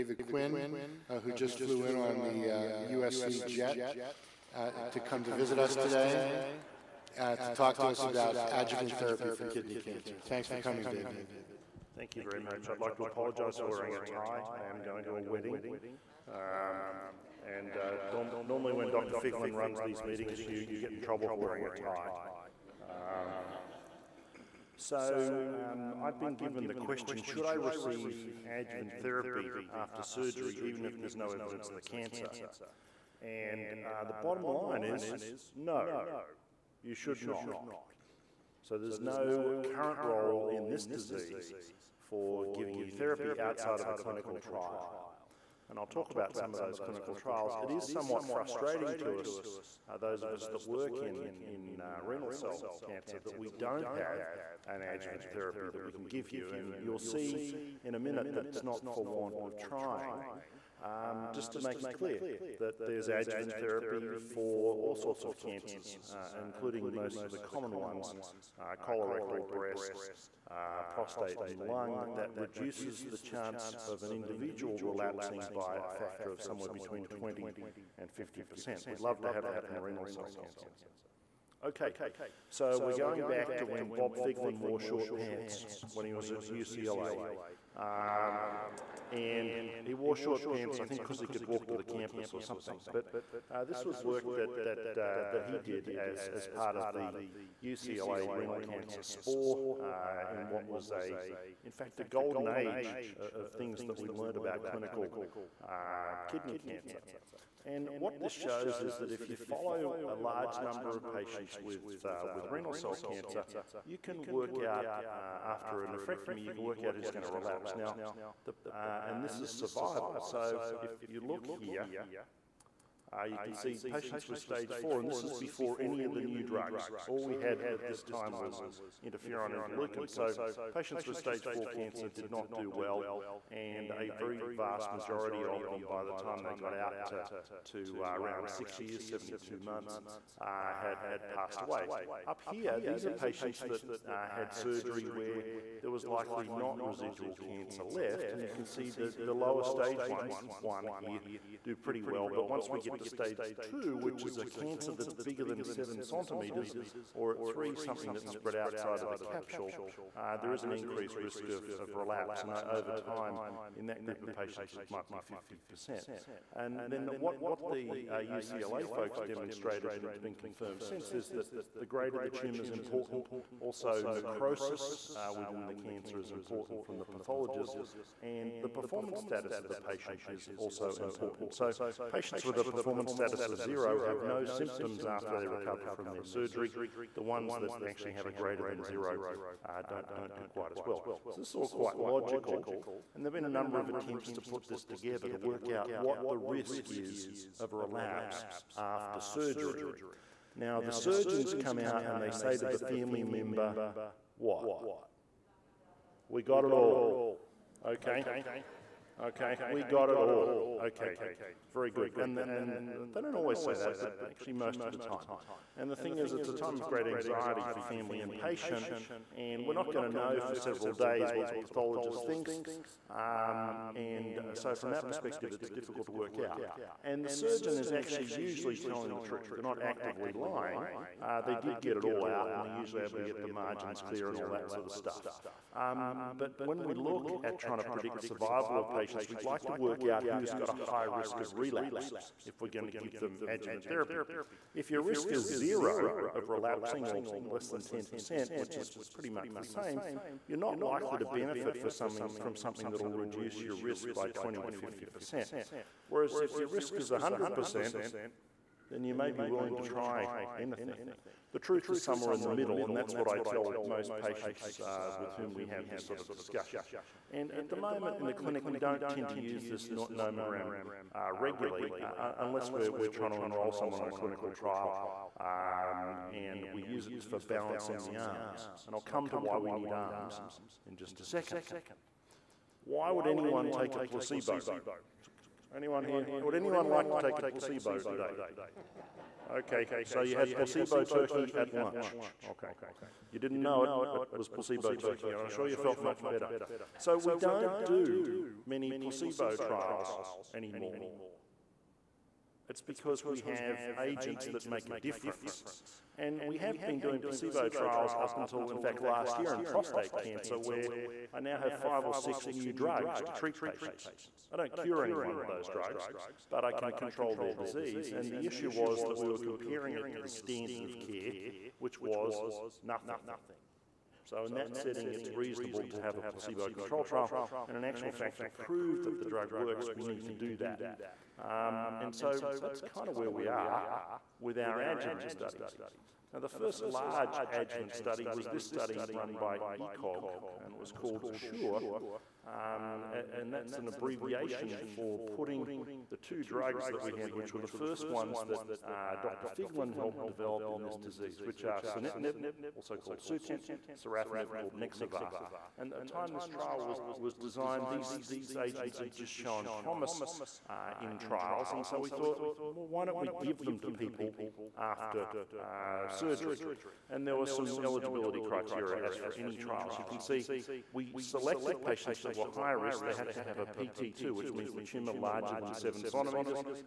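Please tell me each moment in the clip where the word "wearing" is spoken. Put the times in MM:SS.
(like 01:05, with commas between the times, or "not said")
00:13, 00:21.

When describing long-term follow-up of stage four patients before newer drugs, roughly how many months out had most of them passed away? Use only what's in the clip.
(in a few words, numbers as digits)
72 months.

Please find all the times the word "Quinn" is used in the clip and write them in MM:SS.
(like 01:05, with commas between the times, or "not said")
00:00.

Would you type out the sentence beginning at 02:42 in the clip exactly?
And uh, over time, in that group of patients, it might be 50%.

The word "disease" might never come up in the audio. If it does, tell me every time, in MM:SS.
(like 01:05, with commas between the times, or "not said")
00:40, 05:17, 05:50.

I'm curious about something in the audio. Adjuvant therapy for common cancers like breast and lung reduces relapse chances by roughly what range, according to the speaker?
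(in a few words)
20 to 50%.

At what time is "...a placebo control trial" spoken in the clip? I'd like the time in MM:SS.
05:26.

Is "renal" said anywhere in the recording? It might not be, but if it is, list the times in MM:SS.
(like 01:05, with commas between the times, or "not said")
00:52, 01:19, 01:38, 01:52.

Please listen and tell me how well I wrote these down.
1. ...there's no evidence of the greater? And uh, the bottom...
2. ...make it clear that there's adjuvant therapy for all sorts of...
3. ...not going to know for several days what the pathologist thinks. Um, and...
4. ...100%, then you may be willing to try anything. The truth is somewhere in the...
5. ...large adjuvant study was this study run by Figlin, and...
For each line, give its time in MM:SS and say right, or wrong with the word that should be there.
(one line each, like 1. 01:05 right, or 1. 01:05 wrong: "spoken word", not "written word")
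1. 00:30 wrong: "cancer", not "greater"
2. 01:01 right
3. 03:39 right
4. 04:17 right
5. 05:36 wrong: "ECOG", not "Figlin".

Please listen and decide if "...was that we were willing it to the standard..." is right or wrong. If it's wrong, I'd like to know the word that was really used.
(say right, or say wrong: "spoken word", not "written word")
wrong: "comparing", not "willing".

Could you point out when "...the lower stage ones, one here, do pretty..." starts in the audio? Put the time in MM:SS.
02:29.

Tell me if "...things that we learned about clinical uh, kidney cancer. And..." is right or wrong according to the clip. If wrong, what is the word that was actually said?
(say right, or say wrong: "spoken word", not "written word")
right.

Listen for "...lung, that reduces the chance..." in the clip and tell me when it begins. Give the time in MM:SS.
01:11.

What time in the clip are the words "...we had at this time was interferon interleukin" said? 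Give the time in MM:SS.
02:07.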